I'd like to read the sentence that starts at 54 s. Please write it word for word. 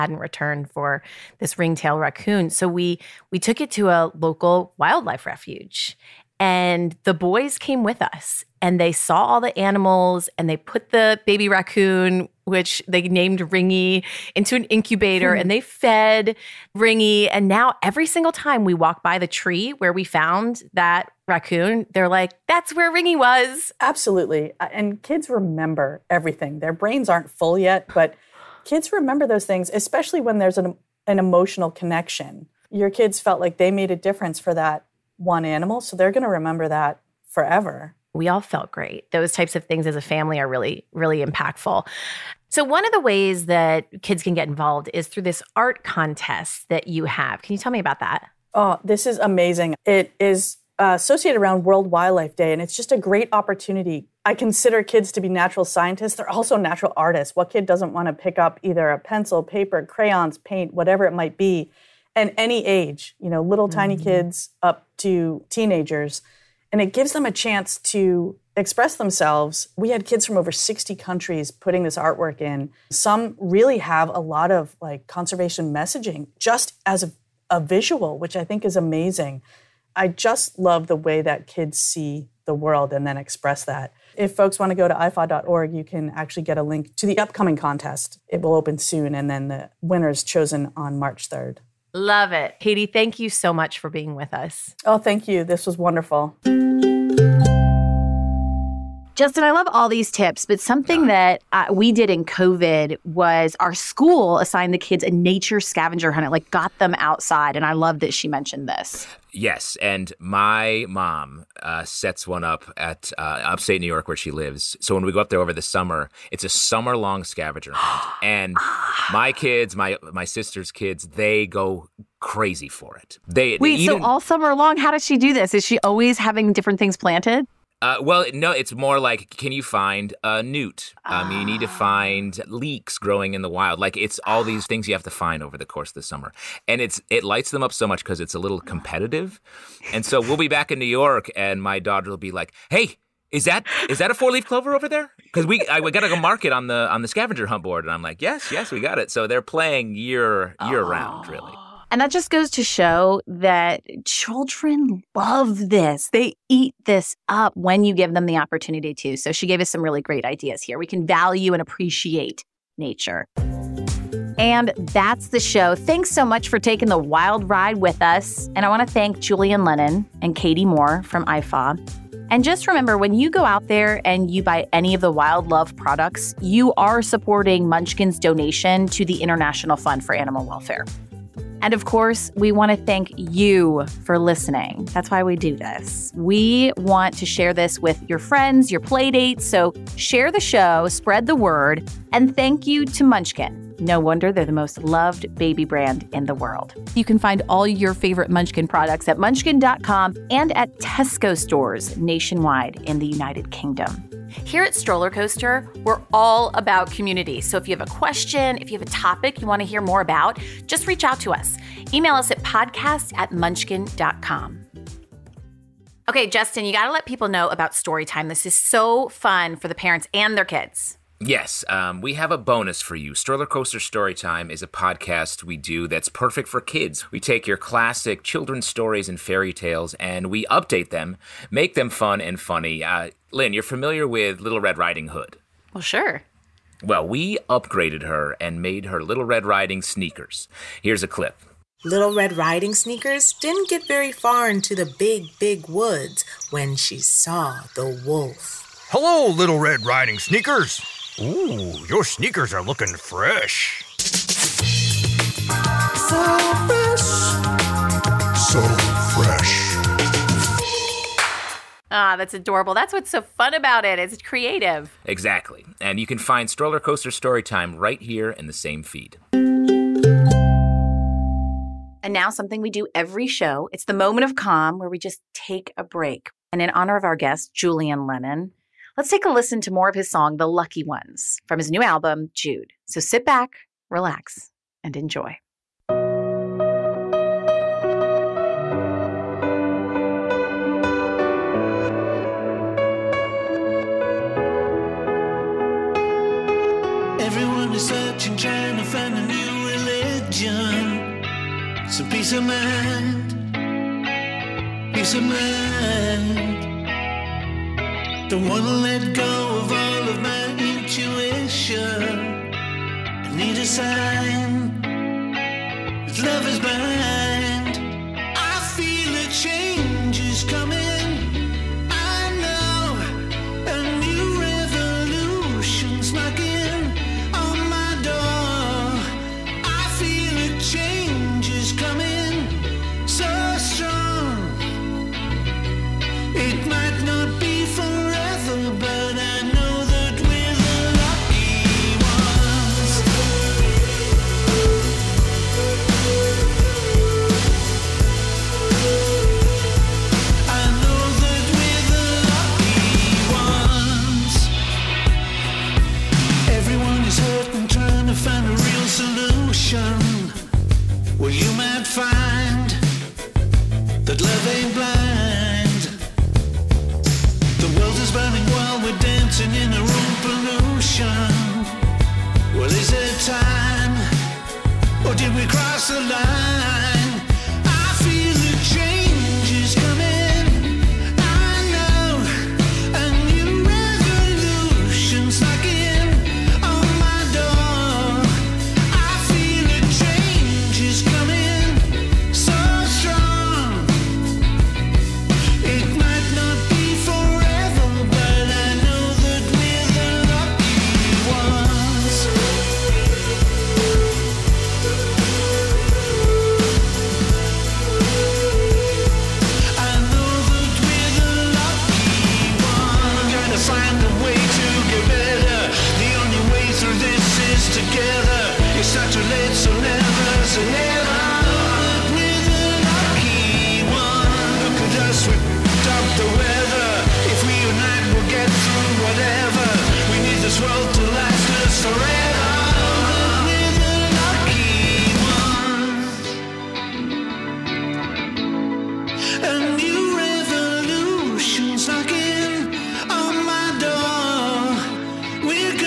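I consider kids to be natural scientists.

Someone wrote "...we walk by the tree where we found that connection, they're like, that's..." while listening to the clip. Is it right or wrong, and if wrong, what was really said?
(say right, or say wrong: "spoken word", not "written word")
wrong: "raccoon", not "connection".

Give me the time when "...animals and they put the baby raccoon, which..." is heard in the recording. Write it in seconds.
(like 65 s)
9 s.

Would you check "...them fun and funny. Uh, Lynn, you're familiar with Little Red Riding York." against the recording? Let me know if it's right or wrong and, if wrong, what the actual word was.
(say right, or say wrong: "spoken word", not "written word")
wrong: "Hood", not "York".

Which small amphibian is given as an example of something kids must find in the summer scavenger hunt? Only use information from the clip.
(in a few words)
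A newt.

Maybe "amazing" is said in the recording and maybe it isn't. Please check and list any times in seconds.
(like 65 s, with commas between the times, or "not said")
49 s, 78 s.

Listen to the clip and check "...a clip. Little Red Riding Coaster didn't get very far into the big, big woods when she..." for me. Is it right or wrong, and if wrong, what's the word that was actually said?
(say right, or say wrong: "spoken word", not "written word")
wrong: "Sneakers", not "Coaster".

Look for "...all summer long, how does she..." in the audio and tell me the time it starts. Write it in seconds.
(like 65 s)
124 s.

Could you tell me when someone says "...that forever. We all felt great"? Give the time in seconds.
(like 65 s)
36 s.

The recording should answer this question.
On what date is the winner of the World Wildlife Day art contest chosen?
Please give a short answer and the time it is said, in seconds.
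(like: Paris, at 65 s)
March 3rd, at 90 s.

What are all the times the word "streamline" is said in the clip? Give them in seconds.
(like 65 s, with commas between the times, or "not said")
not said.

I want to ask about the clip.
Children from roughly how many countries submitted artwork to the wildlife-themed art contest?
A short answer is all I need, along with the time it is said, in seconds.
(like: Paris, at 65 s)
60, at 70 s.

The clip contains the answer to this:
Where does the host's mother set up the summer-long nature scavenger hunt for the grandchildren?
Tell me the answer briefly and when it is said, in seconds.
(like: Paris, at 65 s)
Upstate New York, at 113 s.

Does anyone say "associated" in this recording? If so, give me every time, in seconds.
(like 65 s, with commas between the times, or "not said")
50 s.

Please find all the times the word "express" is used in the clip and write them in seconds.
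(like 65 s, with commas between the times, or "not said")
68 s, 83 s.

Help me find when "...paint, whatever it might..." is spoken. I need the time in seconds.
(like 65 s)
60 s.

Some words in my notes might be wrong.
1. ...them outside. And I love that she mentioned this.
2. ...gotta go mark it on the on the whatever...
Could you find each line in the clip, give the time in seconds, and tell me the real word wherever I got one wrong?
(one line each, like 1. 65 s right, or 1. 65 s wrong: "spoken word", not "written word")
1. 106 s right
2. 145 s wrong: "scavenger", not "whatever".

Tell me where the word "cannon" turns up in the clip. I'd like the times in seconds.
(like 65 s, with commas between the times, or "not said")
not said.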